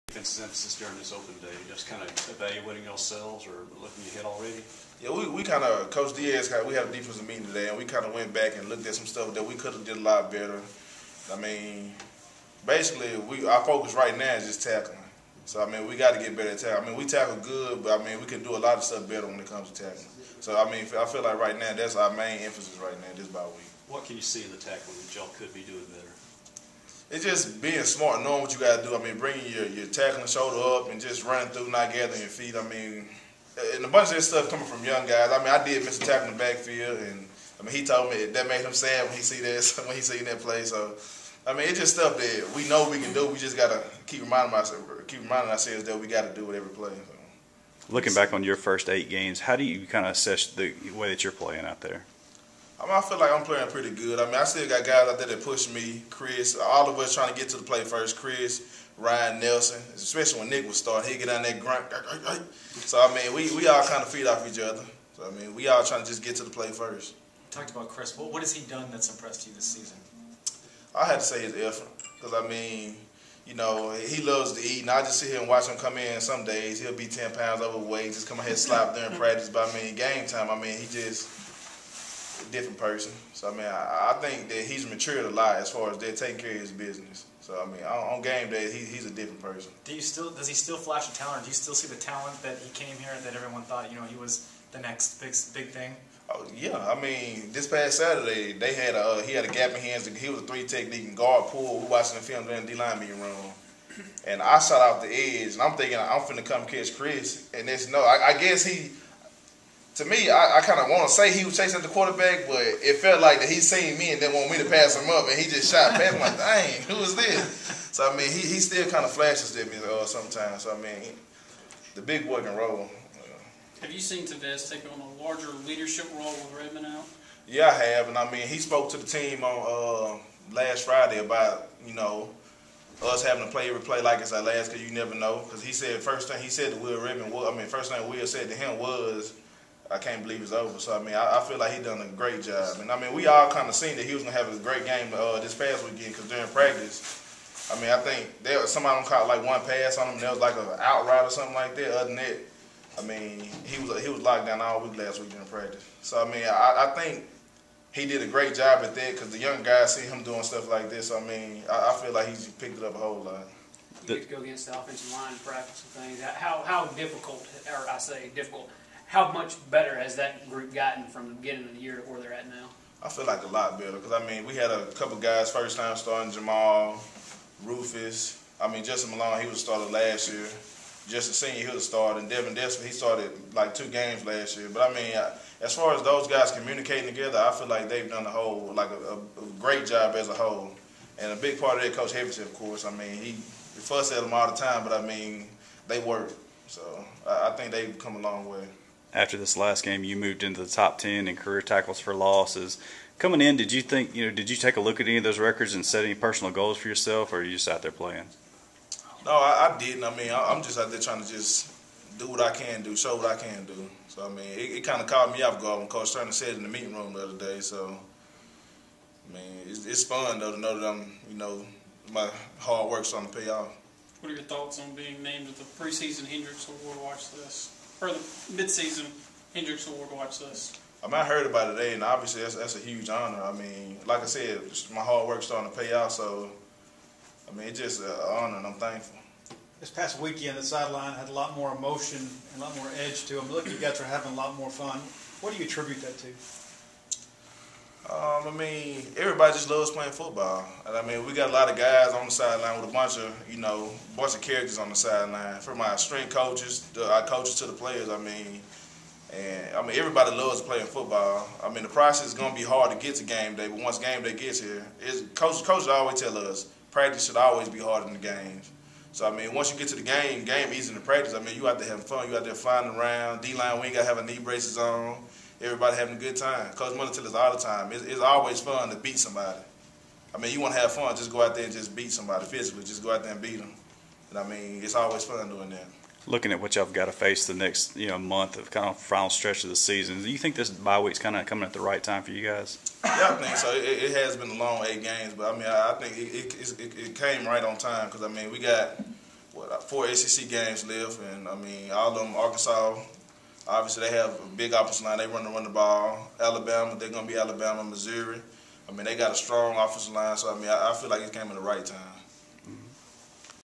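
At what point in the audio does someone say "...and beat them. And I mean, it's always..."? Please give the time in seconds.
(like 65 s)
283 s.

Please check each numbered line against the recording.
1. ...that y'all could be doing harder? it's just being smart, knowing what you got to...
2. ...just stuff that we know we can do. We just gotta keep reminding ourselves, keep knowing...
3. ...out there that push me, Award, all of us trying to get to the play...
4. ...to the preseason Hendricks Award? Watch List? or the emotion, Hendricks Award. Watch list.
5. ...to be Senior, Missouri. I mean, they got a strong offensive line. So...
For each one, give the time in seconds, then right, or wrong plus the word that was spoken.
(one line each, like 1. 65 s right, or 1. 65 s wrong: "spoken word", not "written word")
1. 25 s wrong: "better", not "harder"
2. 41 s wrong: "reminding", not "knowing"
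3. 55 s wrong: "Chris", not "Award"
4. 225 s wrong: "midseason", not "emotion"
5. 307 s wrong: "Alabama", not "Senior".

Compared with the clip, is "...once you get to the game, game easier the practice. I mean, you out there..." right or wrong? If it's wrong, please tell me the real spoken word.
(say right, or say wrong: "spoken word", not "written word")
right.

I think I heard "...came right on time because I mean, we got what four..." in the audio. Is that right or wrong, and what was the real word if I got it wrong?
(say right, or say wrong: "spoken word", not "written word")
right.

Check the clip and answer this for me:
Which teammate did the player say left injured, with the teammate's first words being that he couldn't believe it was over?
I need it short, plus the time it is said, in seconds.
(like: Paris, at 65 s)
Will Redmond, at 136 s.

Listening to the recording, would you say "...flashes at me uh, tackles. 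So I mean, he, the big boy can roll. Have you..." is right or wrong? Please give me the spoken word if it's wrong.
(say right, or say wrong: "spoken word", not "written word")
wrong: "sometimes", not "tackles".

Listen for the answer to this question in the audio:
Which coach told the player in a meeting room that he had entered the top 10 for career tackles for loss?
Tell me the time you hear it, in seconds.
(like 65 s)
215 s.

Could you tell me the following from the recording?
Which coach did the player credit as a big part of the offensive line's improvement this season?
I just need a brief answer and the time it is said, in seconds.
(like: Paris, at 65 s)
Coach Heverson, at 191 s.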